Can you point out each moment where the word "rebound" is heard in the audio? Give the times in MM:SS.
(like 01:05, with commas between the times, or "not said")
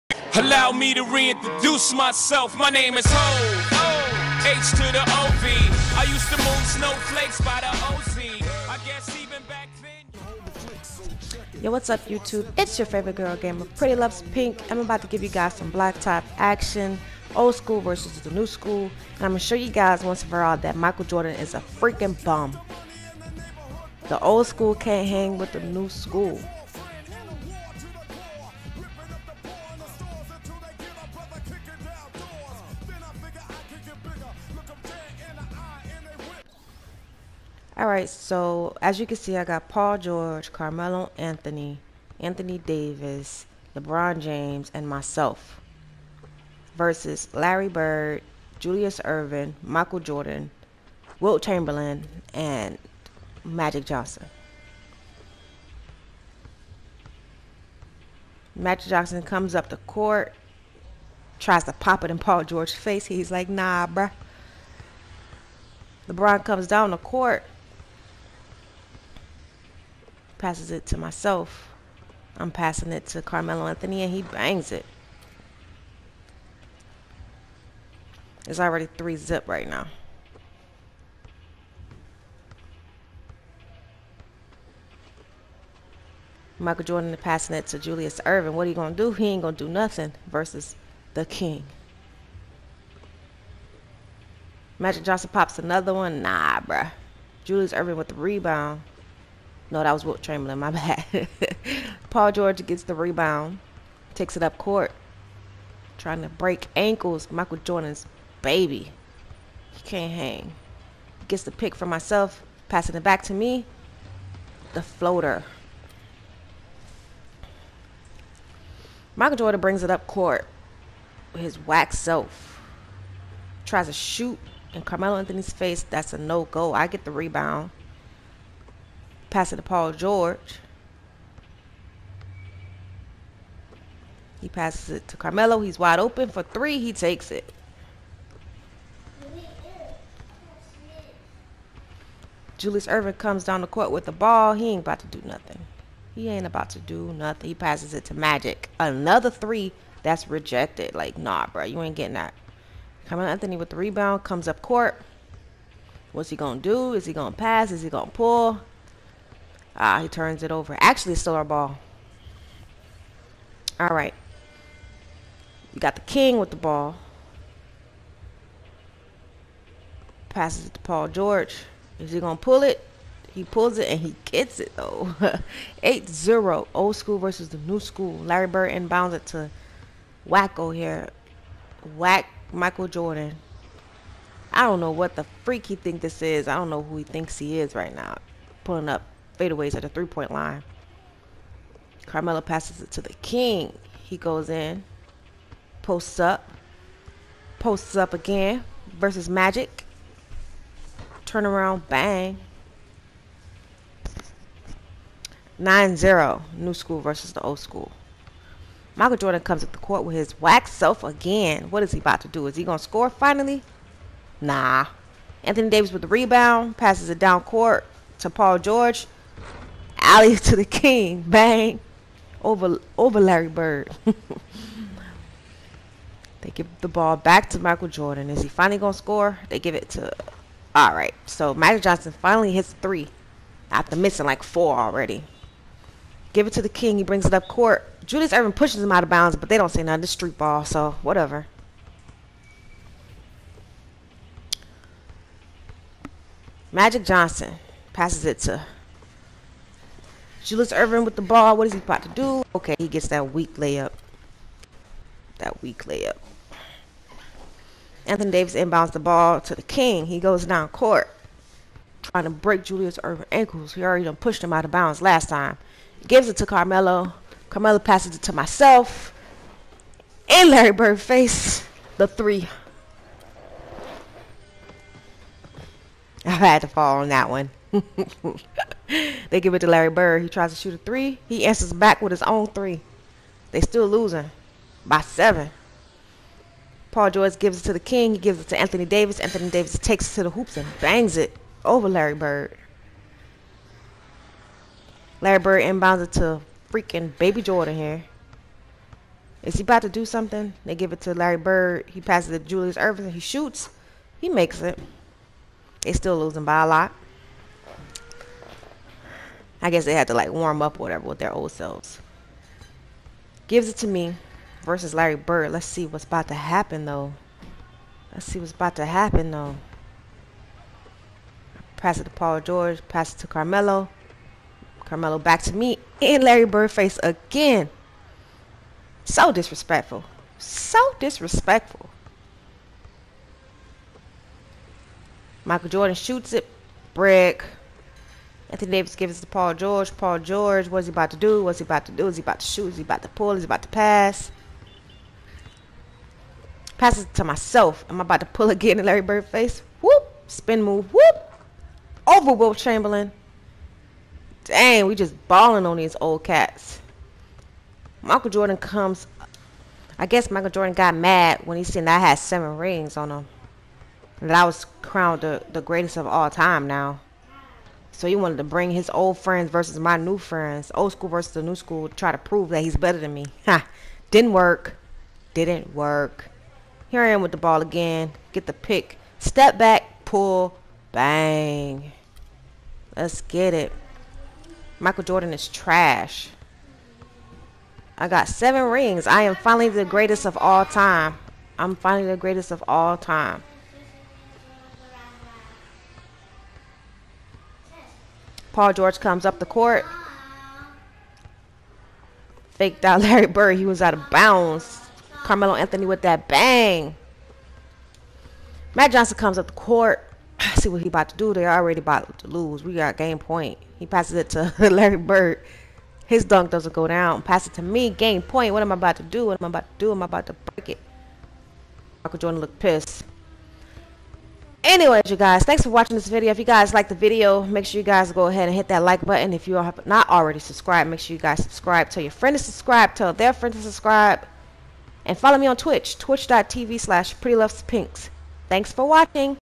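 01:38, 01:42, 02:07, 02:33, 03:36.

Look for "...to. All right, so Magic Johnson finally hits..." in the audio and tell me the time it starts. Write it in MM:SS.
03:49.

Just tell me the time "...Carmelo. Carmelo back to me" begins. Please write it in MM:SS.
05:23.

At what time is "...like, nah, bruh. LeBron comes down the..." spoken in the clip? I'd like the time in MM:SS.
01:03.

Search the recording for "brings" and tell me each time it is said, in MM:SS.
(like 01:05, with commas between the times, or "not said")
01:59, 03:57, 06:08.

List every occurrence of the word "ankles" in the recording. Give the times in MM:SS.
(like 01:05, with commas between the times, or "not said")
01:46, 04:23.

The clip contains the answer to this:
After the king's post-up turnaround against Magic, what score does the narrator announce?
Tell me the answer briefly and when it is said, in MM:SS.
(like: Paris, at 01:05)
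9 0, at 03:25.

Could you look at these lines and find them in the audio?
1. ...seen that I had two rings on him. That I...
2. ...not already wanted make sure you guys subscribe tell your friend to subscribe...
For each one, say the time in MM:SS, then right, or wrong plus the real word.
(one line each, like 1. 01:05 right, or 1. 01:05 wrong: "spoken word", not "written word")
1. 06:01 wrong: "seven", not "two"
2. 07:09 wrong: "subscribed", not "wanted".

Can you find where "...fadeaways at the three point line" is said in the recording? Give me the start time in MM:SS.
03:09.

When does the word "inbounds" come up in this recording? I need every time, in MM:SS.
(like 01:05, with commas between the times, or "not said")
02:58, 04:18, 04:55.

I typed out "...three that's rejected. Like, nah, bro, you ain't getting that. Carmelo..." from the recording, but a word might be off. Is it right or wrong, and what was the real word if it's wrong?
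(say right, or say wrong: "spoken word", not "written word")
right.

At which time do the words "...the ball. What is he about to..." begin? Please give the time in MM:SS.
04:11.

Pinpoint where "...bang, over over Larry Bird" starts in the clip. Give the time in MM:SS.
03:41.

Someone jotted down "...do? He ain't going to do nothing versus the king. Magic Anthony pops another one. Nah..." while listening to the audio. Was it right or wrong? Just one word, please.
wrong.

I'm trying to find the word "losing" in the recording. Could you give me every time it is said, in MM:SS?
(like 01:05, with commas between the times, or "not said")
04:43, 05:06.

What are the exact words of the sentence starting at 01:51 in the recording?
Gets the pick for myself, passing it back to me.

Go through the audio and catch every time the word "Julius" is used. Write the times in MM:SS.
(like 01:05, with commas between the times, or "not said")
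00:48, 01:27, 01:37, 02:22, 03:58, 04:10, 04:22, 05:02.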